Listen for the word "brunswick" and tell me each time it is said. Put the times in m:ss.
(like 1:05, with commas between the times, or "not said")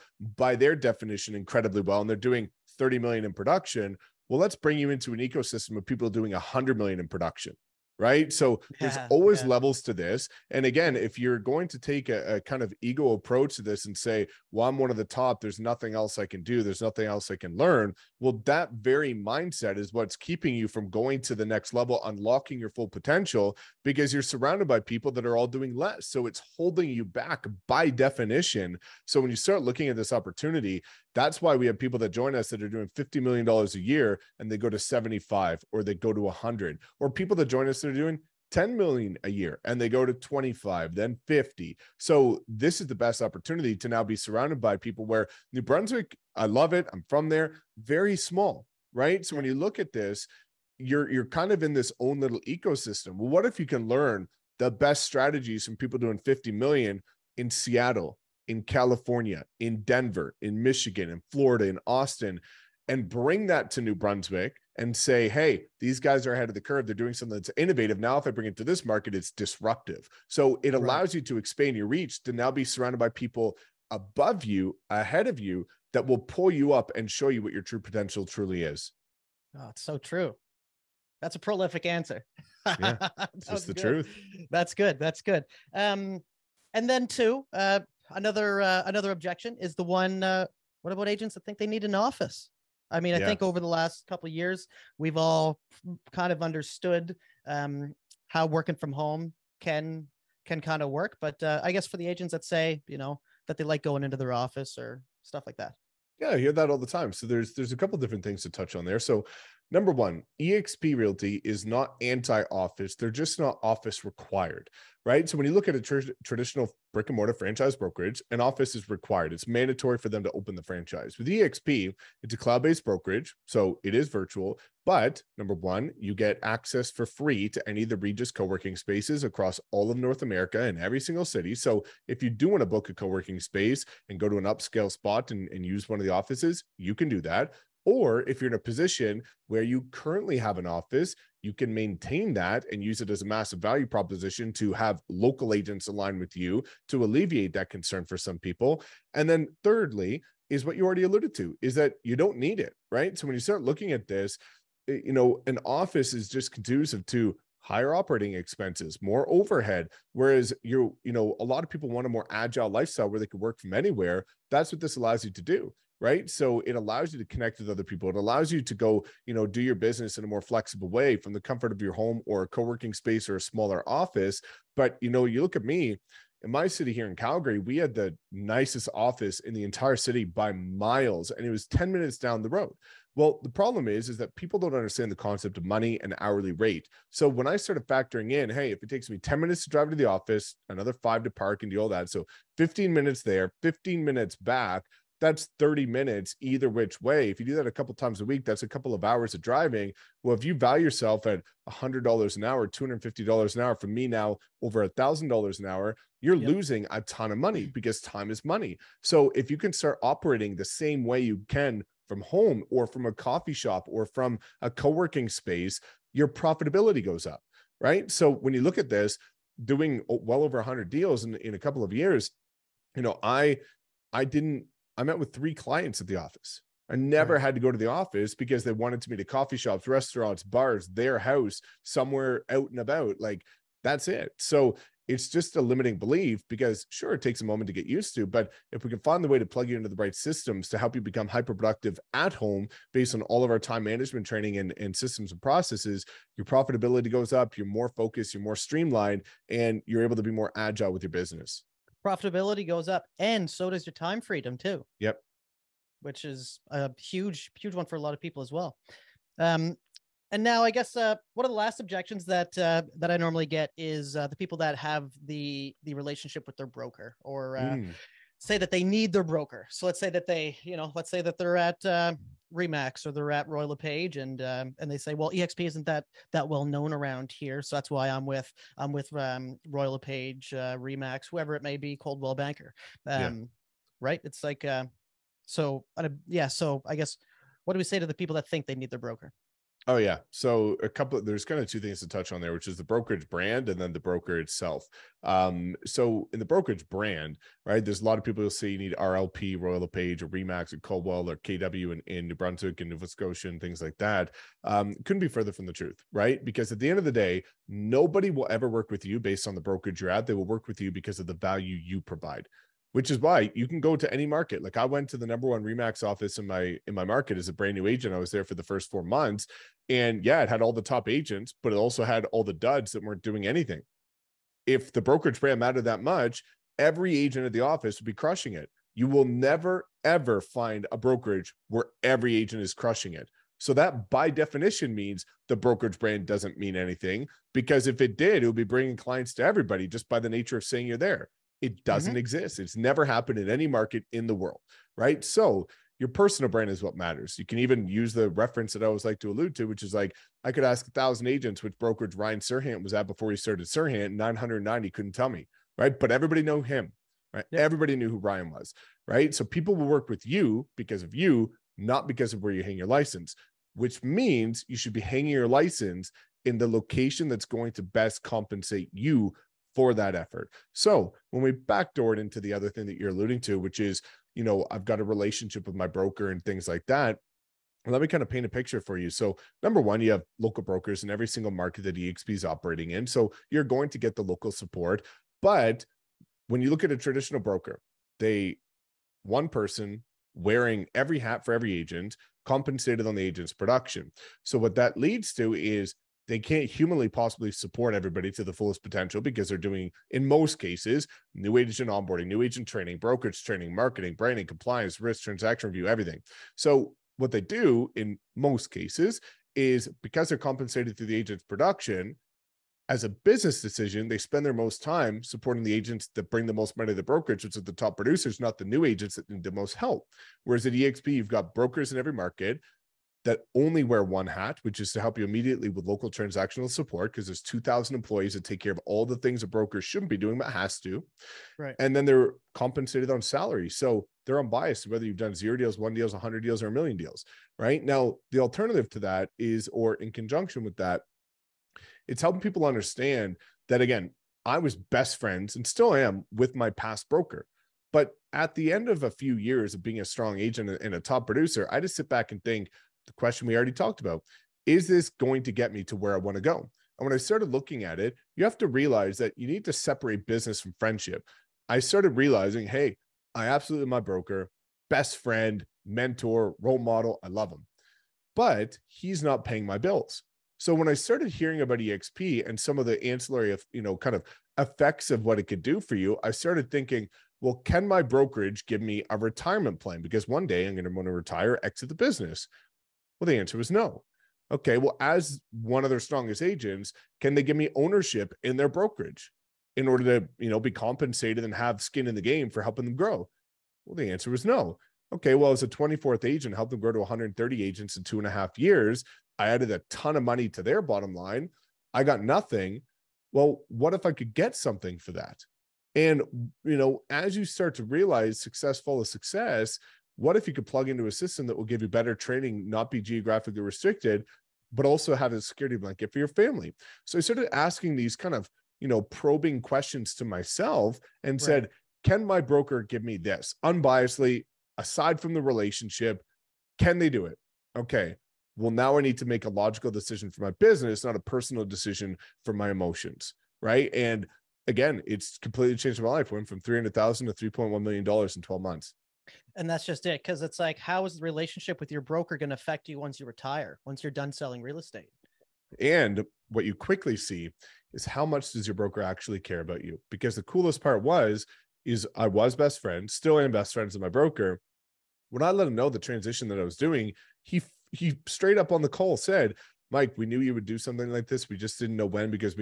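0:45, 1:03, 5:02.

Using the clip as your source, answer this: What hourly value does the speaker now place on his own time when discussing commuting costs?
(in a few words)
over $1,000 an hour.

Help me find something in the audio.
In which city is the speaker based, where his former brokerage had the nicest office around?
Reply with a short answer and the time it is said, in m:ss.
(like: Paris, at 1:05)
Calgary, at 2:57.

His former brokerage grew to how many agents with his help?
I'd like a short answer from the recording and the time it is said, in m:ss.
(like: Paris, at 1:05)
130, at 8:16.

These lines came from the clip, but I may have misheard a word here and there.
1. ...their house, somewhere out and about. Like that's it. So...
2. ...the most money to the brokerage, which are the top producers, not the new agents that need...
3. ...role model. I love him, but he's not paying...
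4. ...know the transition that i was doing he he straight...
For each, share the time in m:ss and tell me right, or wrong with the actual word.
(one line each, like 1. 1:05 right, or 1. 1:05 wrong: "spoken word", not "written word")
1. 3:50 right
2. 6:56 right
3. 7:46 right
4. 9:15 right.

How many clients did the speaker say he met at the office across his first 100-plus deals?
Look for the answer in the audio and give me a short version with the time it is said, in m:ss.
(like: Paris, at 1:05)
3, at 3:45.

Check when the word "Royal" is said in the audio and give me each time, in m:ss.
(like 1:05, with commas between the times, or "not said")
4:33, 4:39, 4:59.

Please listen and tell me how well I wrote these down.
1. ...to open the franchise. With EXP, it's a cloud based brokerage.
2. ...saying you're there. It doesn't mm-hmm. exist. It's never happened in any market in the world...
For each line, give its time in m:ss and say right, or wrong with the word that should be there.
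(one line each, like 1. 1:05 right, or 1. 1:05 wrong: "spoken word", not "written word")
1. 2:00 right
2. 5:40 right.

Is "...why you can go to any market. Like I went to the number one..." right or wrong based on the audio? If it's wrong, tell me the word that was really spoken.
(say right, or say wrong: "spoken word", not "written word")
right.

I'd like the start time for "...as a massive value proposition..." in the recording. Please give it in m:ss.
2:23.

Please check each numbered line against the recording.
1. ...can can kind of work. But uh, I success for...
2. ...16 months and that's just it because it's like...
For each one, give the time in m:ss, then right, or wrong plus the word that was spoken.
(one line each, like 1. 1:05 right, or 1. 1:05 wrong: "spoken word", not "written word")
1. 1:39 wrong: "guess", not "success"
2. 8:58 wrong: "12", not "16".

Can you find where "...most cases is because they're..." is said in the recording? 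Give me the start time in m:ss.
6:48.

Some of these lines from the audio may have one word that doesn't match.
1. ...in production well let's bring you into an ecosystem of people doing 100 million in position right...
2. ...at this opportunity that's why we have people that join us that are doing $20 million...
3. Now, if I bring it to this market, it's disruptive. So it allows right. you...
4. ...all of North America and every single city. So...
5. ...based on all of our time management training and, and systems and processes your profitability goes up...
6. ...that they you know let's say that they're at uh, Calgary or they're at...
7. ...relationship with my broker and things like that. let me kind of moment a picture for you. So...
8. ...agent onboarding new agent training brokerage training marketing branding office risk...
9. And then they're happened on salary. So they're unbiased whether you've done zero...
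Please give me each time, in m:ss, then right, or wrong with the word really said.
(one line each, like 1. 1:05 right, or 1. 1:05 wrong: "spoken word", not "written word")
1. 0:03 wrong: "production", not "position"
2. 0:29 wrong: "50", not "20"
3. 1:07 right
4. 2:09 right
5. 4:02 right
6. 4:30 wrong: "Remax", not "Calgary"
7. 6:15 wrong: "paint", not "moment"
8. 6:41 wrong: "compliance", not "office"
9. 7:11 wrong: "compensated", not "happened".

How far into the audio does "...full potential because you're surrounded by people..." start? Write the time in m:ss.
0:22.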